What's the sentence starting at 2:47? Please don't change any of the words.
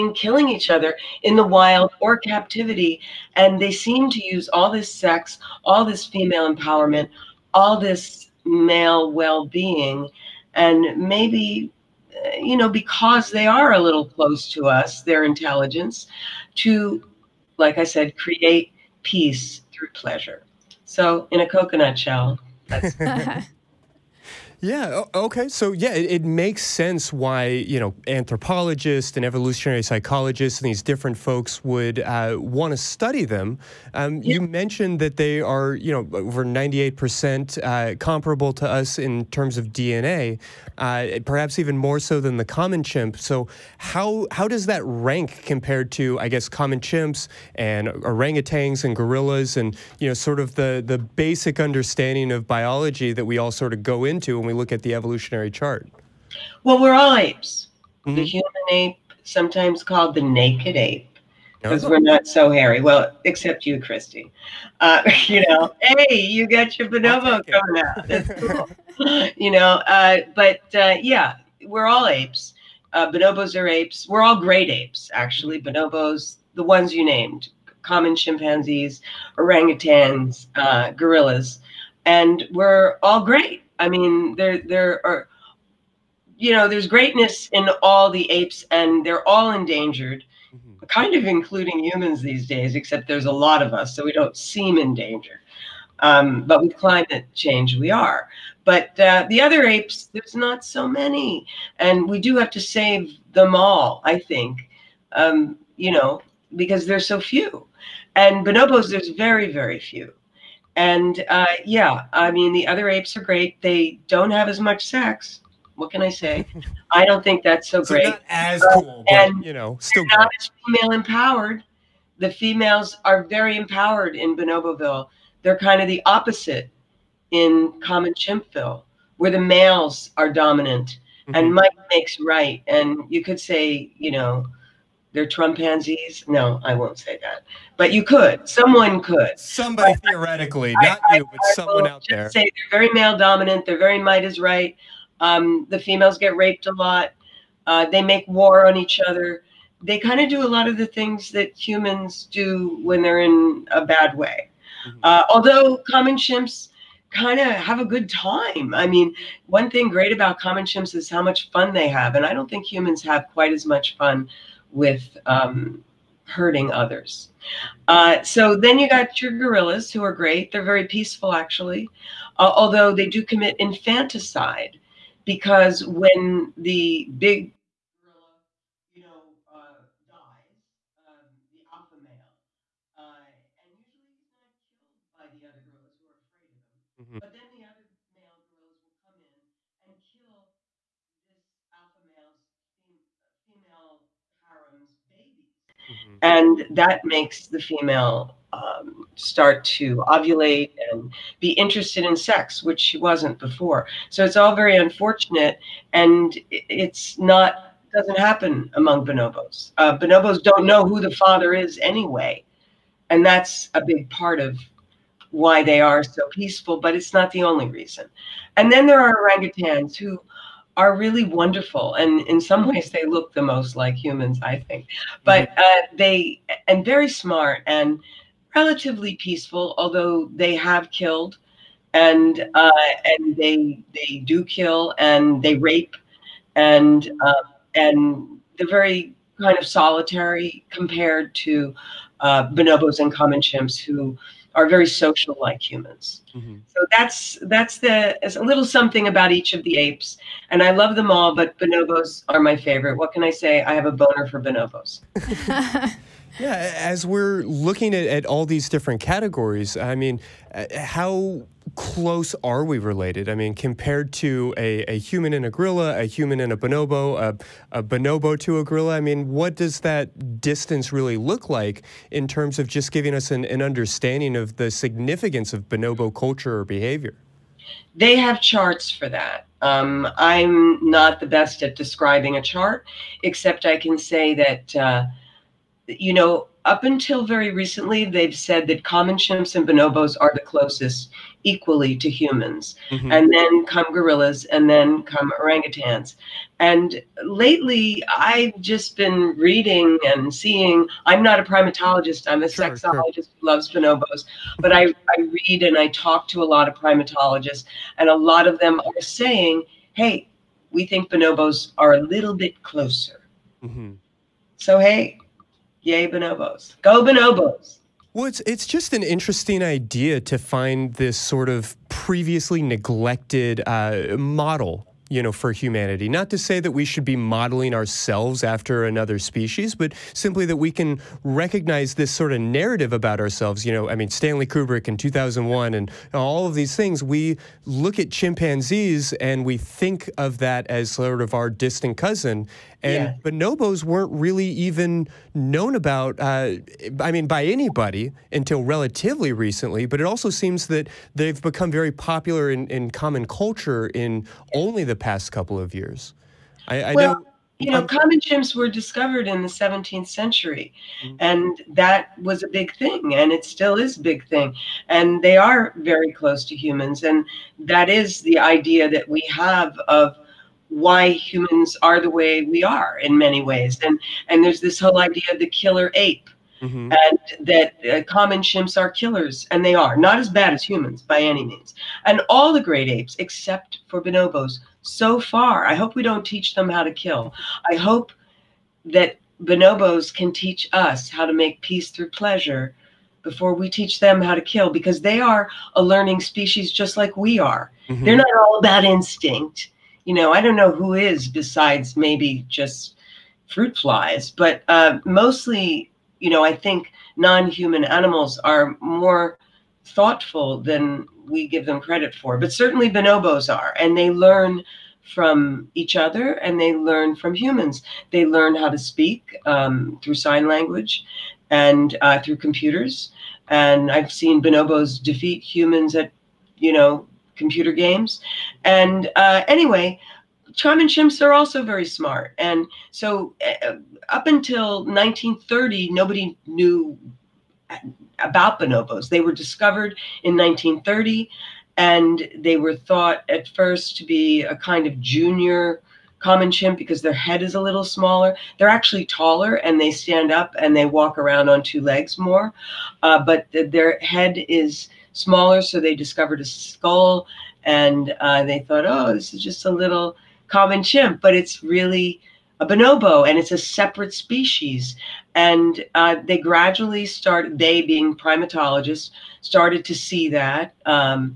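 Uh, so then you got your gorillas, who are great.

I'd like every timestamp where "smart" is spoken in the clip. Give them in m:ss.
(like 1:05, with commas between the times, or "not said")
3:47, 7:11.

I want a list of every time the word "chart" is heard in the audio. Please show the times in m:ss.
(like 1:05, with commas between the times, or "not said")
0:55, 4:38, 4:42.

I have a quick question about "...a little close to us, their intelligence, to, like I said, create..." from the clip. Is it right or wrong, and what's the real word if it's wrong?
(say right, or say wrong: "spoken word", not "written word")
right.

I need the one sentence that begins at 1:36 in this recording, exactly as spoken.
Um, but with climate change, we are.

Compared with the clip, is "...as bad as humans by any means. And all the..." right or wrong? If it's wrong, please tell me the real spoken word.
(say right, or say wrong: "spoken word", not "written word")
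right.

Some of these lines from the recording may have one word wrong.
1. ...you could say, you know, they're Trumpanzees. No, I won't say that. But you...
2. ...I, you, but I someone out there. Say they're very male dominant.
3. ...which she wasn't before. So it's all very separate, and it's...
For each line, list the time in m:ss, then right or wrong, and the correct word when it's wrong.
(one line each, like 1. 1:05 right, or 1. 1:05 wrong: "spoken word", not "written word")
1. 2:13 right
2. 2:21 right
3. 3:22 wrong: "unfortunate", not "separate".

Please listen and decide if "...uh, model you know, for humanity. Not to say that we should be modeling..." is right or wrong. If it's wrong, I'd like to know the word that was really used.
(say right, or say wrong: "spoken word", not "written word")
right.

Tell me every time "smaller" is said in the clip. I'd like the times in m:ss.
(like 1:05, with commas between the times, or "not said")
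7:27, 7:35.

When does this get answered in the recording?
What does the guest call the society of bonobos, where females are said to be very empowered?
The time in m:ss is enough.
2:04.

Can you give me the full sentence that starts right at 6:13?
And and there's this whole idea of the killer ape, mm-hmm.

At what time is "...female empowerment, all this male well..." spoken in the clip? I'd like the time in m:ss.
0:06.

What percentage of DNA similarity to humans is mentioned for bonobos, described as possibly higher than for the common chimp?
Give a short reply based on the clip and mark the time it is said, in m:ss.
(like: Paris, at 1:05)
over 98 percent, at 0:36.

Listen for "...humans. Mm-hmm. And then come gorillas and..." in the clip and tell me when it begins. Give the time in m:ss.
4:52.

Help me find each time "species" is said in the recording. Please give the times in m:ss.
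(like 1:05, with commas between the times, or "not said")
5:29, 6:36, 7:44.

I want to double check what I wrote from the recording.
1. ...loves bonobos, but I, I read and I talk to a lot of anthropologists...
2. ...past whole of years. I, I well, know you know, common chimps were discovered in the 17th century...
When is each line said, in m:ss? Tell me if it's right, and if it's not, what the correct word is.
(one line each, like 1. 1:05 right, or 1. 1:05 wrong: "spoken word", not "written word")
1. 5:03 wrong: "primatologists", not "anthropologists"
2. 5:54 wrong: "couple", not "whole".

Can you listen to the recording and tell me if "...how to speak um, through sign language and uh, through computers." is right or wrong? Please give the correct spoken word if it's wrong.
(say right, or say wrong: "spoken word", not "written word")
right.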